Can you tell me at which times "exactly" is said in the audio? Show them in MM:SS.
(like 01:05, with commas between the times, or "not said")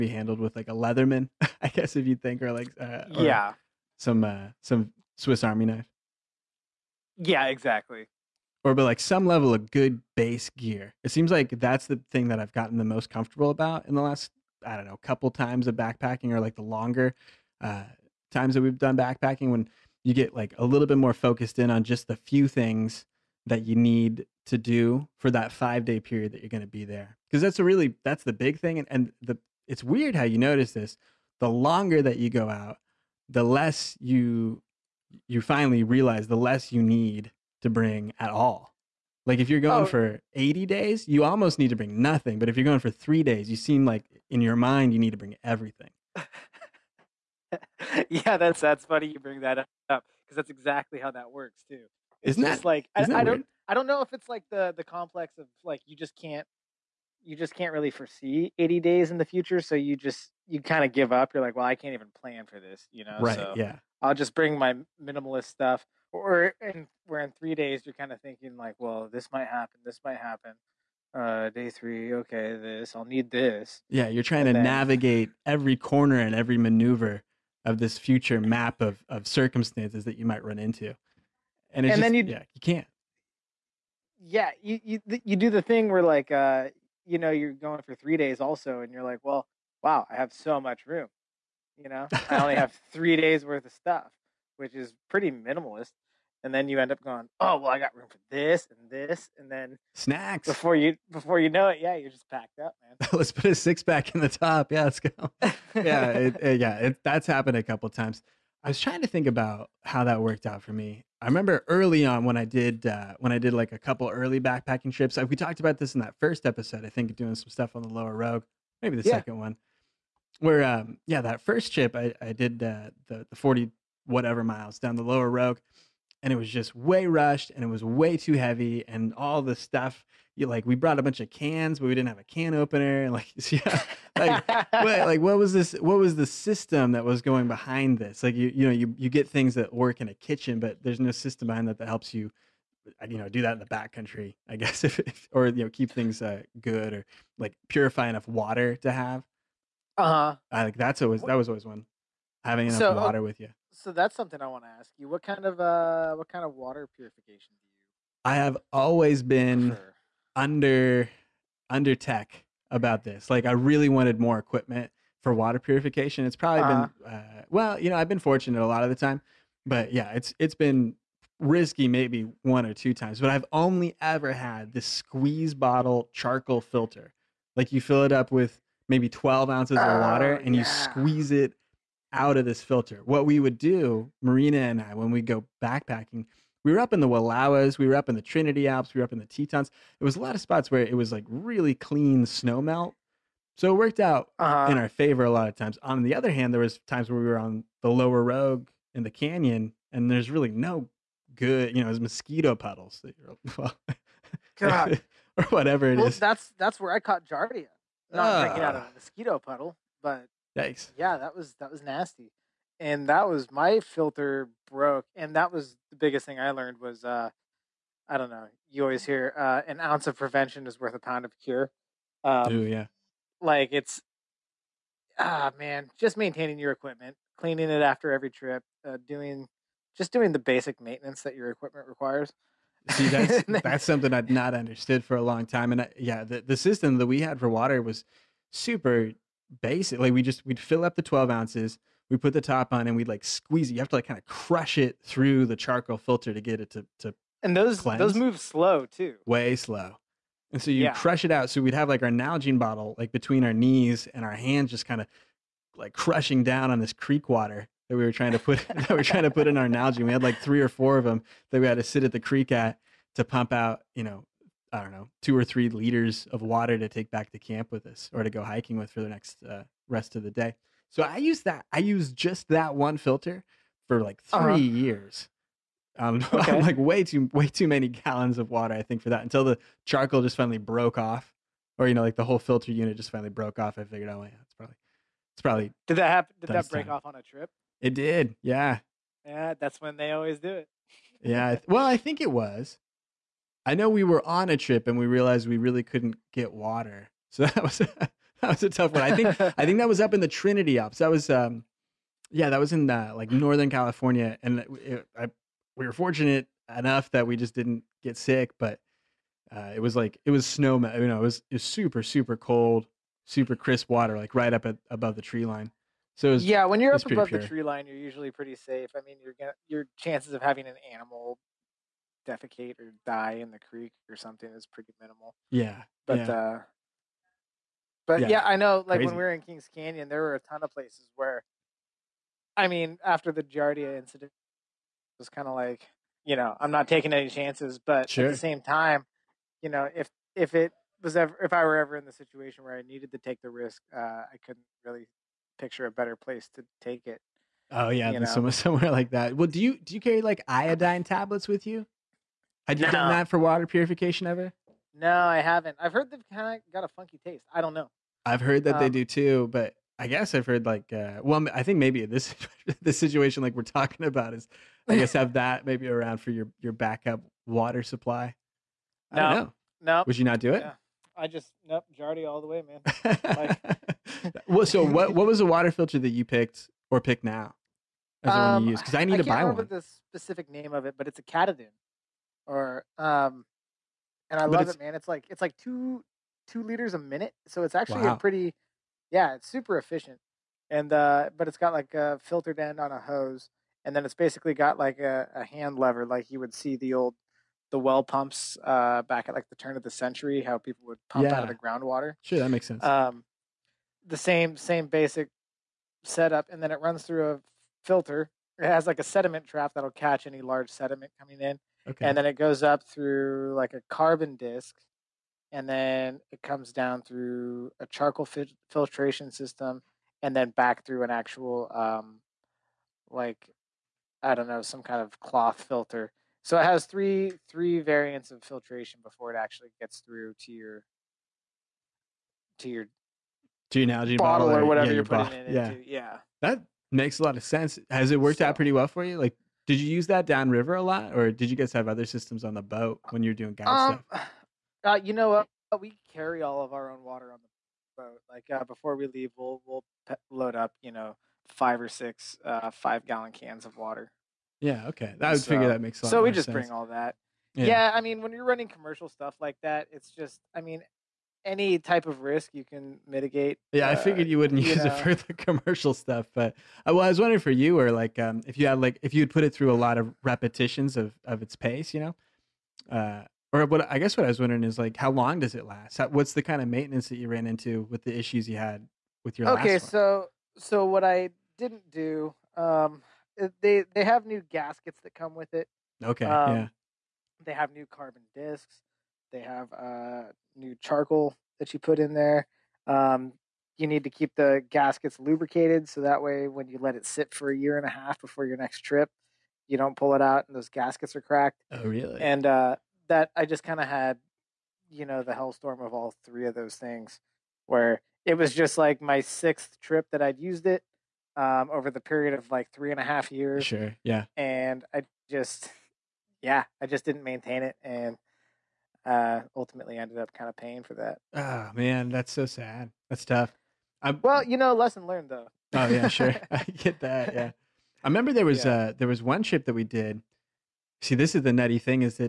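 00:07, 00:50.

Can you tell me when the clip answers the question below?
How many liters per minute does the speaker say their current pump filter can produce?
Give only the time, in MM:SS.
06:25.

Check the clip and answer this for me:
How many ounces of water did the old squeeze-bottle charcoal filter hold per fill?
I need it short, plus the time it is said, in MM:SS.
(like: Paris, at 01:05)
12 ounces, at 02:59.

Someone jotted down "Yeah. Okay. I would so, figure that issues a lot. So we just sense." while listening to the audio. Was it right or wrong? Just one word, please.
wrong.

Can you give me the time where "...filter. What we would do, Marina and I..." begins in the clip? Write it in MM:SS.
03:02.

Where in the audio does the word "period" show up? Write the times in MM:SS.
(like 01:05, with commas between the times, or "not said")
00:25, 08:31.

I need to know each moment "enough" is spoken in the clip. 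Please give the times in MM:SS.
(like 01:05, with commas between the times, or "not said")
02:28, 02:32, 05:06.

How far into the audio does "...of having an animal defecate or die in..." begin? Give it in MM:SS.
05:20.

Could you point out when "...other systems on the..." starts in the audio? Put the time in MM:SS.
07:21.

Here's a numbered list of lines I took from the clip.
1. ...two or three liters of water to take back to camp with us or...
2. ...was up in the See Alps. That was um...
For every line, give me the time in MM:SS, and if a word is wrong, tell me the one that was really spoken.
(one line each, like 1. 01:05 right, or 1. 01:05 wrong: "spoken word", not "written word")
1. 04:25 right
2. 04:59 wrong: "Trinity", not "See".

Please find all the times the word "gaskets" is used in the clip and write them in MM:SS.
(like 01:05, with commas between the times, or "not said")
08:04, 08:14, 08:20.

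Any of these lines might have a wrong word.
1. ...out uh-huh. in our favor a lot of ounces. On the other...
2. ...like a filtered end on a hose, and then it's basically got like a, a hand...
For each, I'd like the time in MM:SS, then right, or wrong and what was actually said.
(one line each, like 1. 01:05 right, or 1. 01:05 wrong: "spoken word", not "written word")
1. 03:13 wrong: "times", not "ounces"
2. 06:31 right.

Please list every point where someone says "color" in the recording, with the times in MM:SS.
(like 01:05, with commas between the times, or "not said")
not said.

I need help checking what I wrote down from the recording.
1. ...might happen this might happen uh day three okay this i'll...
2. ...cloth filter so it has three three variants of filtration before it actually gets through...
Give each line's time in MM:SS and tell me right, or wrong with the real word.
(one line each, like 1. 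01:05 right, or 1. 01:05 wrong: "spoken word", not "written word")
1. 01:09 right
2. 07:05 right.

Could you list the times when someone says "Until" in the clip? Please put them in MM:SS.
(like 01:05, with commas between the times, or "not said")
04:39.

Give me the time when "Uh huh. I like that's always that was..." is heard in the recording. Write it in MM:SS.
02:29.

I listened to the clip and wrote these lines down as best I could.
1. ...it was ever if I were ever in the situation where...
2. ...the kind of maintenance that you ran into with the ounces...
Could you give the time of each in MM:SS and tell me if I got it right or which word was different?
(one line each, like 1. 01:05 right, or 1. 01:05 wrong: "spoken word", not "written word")
1. 05:40 right
2. 07:56 wrong: "issues", not "ounces".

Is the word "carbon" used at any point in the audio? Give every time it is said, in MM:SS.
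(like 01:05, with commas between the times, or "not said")
06:53, 08:07.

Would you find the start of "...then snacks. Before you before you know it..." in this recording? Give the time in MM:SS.
01:39.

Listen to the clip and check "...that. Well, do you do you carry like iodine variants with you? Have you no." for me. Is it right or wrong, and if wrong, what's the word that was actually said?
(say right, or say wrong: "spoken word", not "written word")
wrong: "tablets", not "variants".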